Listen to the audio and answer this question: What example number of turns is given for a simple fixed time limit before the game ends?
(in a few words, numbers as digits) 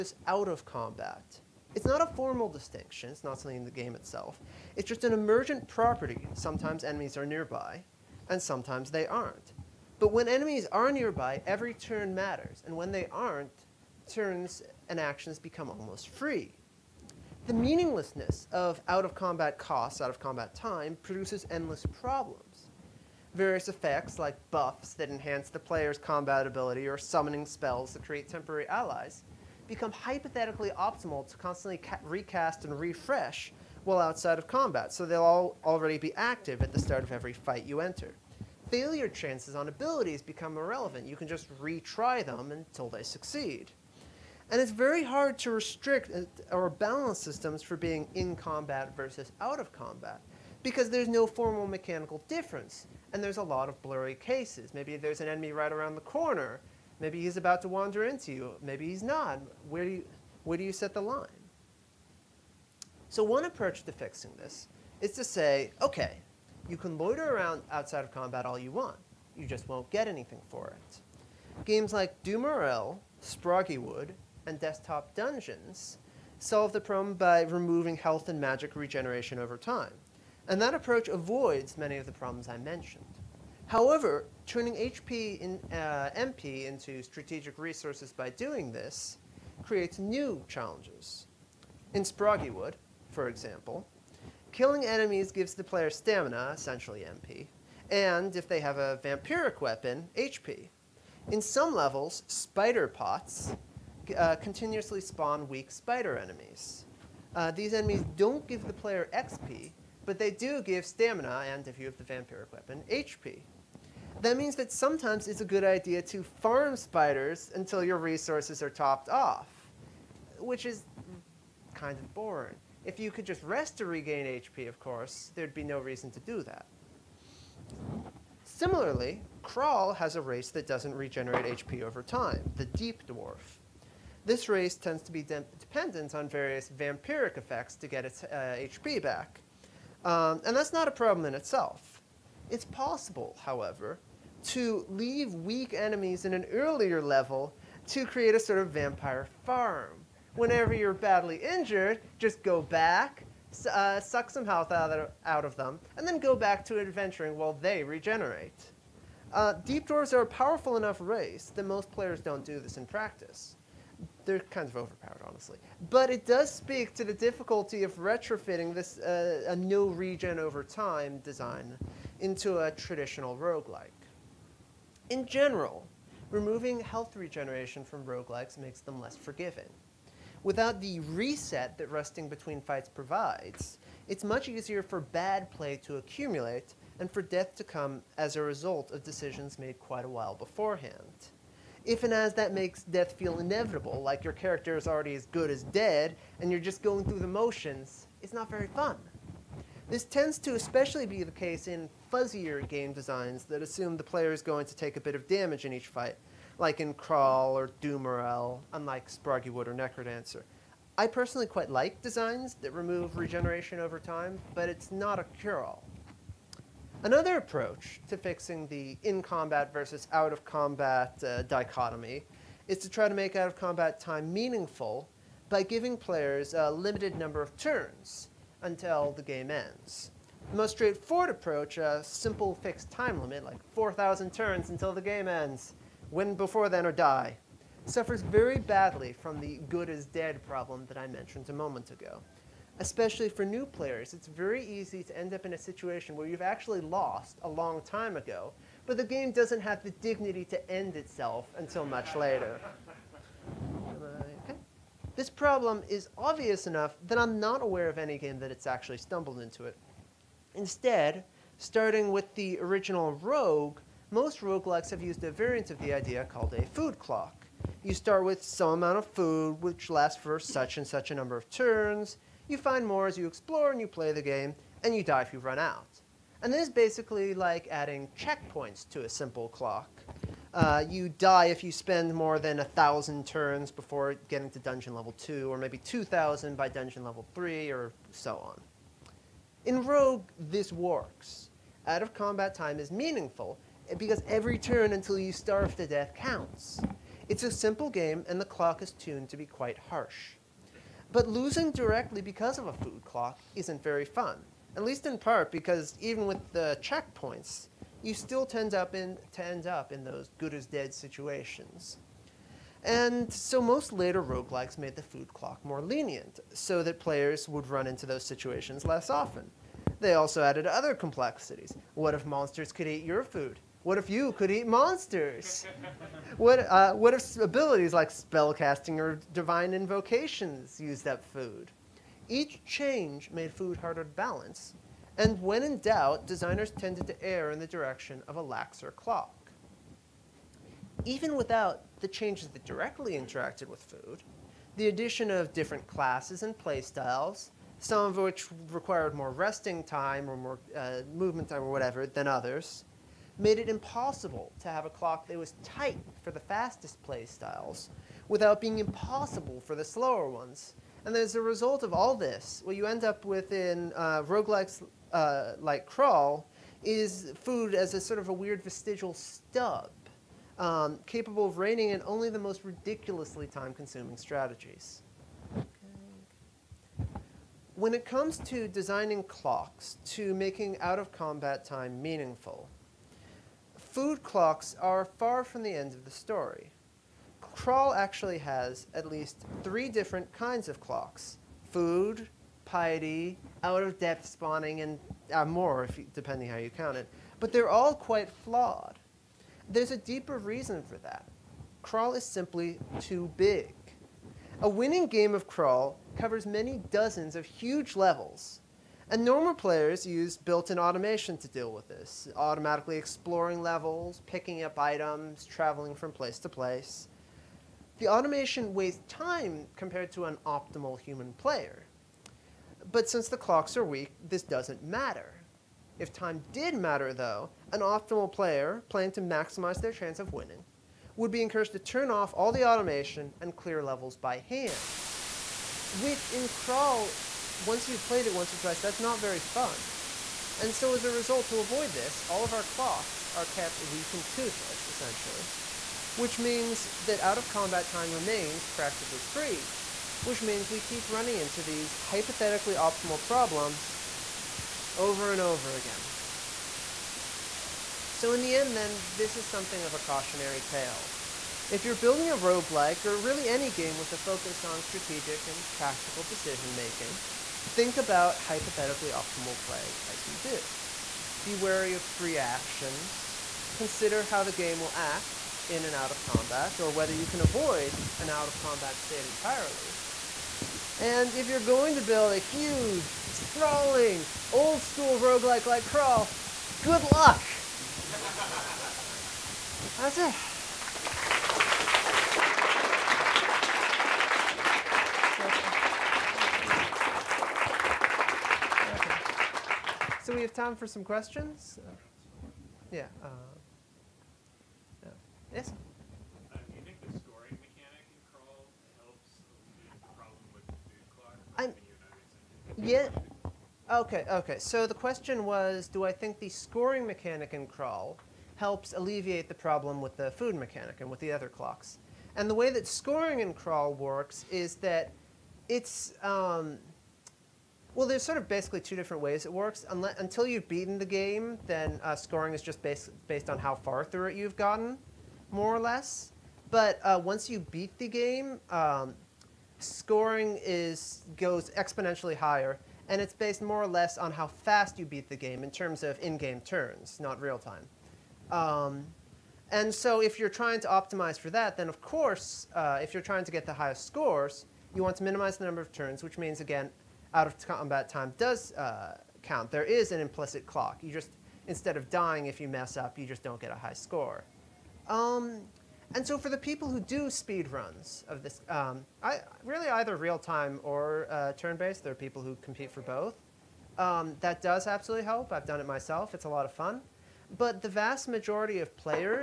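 4,000.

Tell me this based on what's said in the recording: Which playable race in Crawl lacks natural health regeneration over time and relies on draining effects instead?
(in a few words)
Deep Dwarf.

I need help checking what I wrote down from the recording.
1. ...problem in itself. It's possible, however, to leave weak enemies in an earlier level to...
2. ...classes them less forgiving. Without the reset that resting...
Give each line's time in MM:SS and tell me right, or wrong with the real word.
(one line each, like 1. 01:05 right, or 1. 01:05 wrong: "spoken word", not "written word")
1. 02:20 right
2. 02:58 wrong: "makes", not "classes".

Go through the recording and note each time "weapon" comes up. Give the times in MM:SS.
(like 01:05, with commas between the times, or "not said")
01:39, 01:52.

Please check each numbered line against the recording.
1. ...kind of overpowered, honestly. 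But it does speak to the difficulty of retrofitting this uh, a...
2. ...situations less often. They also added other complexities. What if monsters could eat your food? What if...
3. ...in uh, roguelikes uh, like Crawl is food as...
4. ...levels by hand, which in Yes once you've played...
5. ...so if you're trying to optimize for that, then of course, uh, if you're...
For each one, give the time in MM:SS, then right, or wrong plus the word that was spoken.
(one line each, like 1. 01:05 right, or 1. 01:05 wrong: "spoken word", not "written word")
1. 02:44 right
2. 05:18 right
3. 06:03 right
4. 07:13 wrong: "Crawl", not "Yes"
5. 09:09 right.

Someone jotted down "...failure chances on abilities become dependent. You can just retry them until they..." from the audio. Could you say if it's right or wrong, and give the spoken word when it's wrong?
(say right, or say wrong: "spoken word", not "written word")
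wrong: "irrelevant", not "dependent".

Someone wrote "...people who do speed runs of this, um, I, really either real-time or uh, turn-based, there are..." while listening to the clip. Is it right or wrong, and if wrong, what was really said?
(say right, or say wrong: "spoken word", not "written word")
right.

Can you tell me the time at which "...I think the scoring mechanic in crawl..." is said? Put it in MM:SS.
08:36.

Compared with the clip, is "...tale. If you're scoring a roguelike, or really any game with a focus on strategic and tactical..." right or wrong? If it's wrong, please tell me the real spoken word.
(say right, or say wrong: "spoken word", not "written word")
wrong: "building", not "scoring".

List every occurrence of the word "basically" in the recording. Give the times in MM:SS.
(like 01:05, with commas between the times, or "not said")
04:36, 08:48.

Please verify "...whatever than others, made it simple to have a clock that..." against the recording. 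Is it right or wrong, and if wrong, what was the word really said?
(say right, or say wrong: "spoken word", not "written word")
wrong: "impossible", not "simple".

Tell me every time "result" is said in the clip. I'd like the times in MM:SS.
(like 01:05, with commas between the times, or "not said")
03:08, 06:01, 07:21.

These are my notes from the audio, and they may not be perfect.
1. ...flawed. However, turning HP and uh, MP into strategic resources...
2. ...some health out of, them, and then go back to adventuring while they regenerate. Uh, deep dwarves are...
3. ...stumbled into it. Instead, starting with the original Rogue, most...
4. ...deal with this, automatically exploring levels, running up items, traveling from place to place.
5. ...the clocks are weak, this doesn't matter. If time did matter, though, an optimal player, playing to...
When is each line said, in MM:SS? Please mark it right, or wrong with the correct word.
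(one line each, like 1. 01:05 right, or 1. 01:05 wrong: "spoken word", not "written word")
1. 01:22 wrong: "mentioned", not "flawed"
2. 02:34 right
3. 04:18 right
4. 06:51 wrong: "picking", not "running"
5. 07:03 right.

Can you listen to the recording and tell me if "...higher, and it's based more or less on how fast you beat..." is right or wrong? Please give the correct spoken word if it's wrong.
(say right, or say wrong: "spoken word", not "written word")
right.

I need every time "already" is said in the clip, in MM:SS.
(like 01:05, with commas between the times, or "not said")
00:35, 03:14.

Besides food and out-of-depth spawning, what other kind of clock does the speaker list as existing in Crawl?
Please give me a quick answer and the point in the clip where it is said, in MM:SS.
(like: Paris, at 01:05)
piety, at 06:32.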